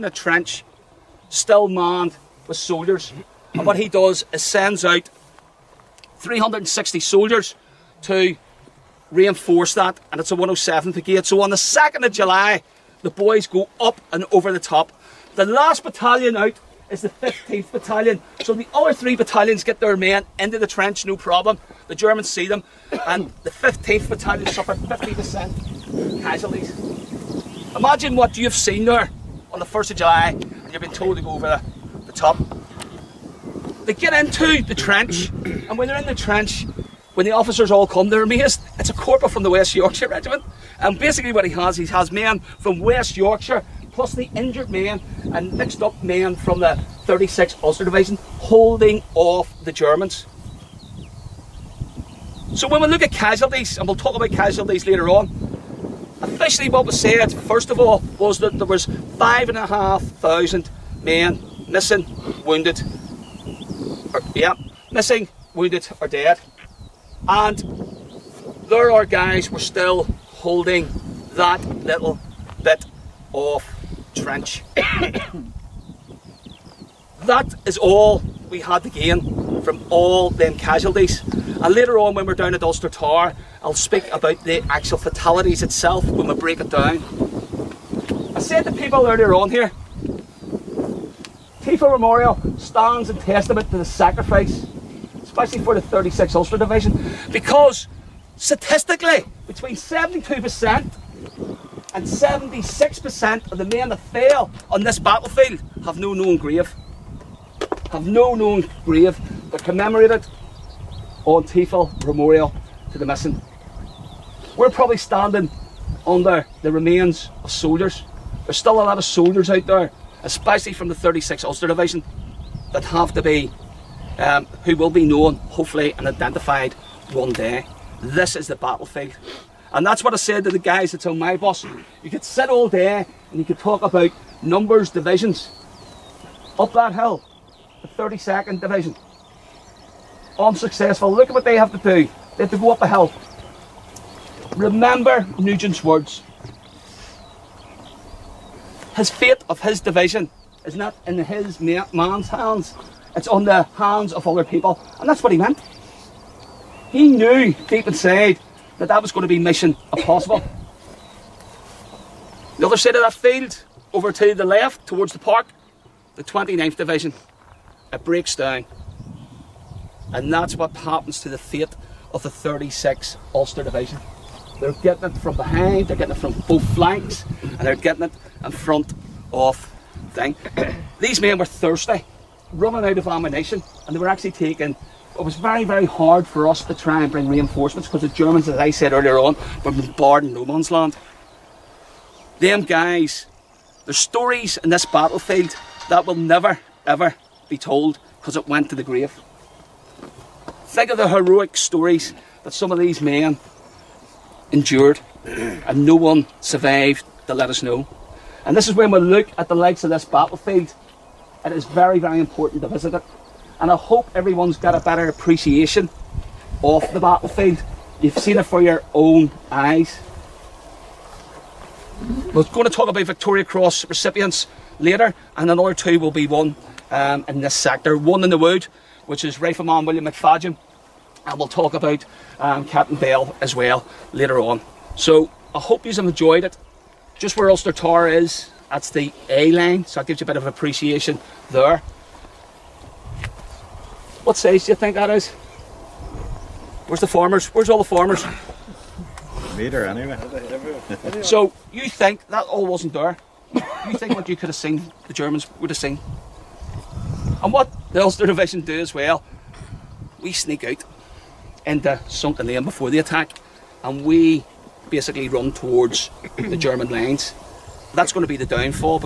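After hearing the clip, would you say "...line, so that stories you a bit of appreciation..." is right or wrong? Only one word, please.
wrong.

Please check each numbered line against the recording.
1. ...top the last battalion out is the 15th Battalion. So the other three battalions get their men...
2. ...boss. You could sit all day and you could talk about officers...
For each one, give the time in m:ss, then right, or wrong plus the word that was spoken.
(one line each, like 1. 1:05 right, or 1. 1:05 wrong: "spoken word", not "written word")
1. 0:14 right
2. 2:11 wrong: "numbers", not "officers".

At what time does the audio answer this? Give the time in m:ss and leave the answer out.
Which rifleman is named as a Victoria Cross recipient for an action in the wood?
3:49.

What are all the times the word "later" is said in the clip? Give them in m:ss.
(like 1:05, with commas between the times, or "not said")
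0:54, 1:21, 3:44, 3:54.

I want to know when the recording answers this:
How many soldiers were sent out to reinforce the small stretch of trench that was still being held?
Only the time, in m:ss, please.
0:06.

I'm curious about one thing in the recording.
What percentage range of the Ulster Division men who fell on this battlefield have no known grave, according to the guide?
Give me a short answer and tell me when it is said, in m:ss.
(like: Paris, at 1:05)
72% to 76%, at 1:39.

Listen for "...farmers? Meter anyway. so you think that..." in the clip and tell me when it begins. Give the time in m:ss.
4:07.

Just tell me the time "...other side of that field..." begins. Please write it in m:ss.
2:42.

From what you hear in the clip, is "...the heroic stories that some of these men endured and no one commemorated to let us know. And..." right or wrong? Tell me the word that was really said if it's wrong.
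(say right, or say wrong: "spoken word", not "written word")
wrong: "survived", not "commemorated".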